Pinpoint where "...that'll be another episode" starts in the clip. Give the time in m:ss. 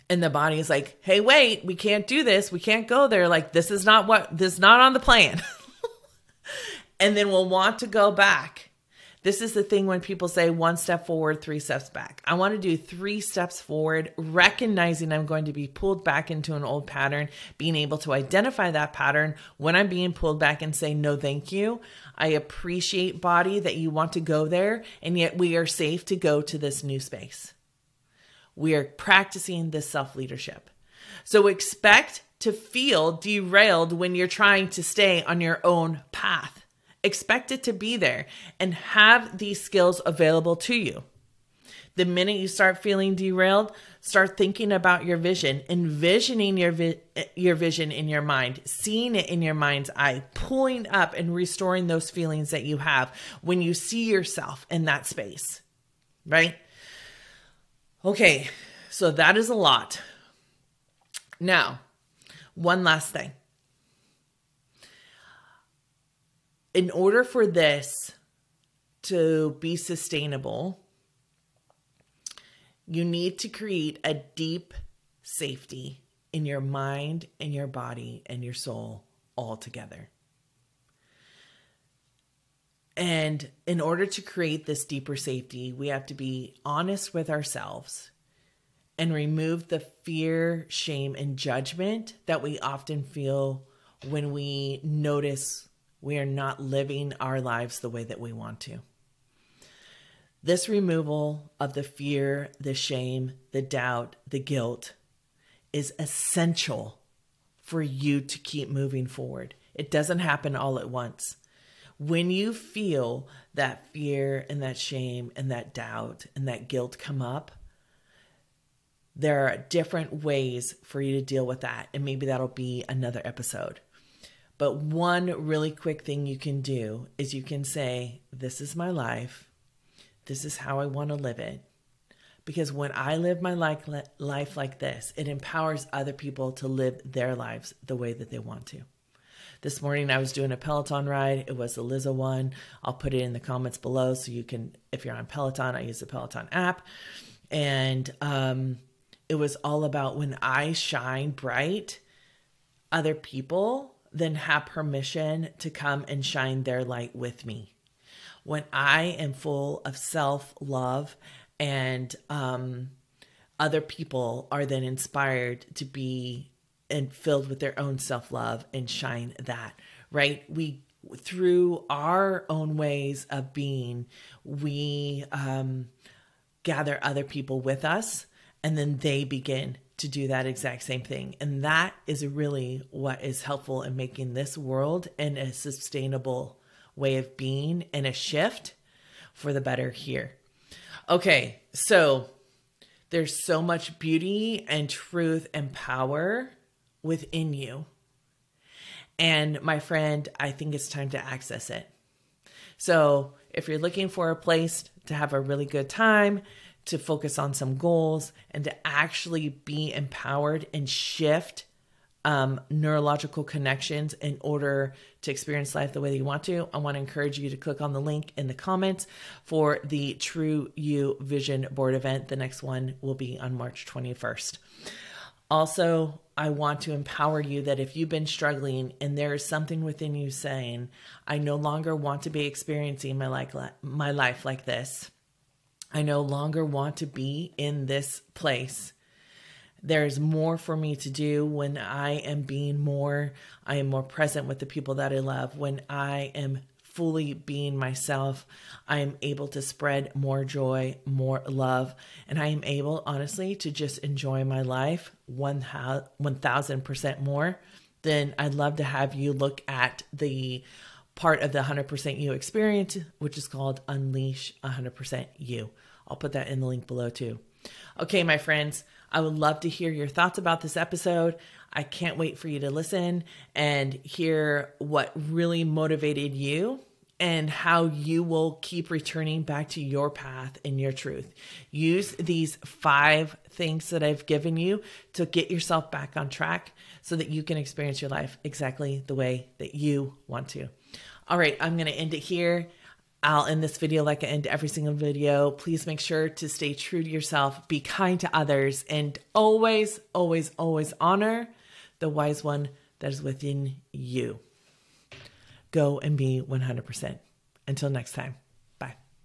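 2:02.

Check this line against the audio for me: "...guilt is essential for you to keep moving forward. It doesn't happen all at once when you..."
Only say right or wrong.
right.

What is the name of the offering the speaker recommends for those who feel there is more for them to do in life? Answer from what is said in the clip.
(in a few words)
Unleash 100% You.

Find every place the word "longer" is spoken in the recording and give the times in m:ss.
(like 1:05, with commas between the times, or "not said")
3:51, 3:56.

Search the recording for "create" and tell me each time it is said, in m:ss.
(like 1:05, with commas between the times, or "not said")
1:13, 1:24.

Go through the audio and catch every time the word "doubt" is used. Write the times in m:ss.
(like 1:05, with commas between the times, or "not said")
1:43, 1:55.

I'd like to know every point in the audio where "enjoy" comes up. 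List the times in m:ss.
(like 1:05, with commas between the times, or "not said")
4:13.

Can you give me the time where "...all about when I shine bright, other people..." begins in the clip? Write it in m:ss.
2:29.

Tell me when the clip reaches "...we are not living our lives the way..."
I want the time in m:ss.
1:36.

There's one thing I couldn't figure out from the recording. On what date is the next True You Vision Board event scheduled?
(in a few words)
March 21.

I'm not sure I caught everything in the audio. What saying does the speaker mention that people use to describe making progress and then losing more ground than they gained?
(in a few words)
One step forward, three steps back.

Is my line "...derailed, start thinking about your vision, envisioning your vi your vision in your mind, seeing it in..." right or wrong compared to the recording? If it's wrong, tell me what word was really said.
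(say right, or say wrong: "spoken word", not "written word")
right.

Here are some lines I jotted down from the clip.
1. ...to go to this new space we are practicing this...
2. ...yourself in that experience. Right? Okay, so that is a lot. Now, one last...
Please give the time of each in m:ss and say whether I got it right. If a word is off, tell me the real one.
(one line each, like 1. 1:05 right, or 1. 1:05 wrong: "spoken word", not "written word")
1. 0:26 right
2. 0:54 wrong: "space", not "experience".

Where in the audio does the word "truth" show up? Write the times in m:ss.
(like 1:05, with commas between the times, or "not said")
3:14, 4:40.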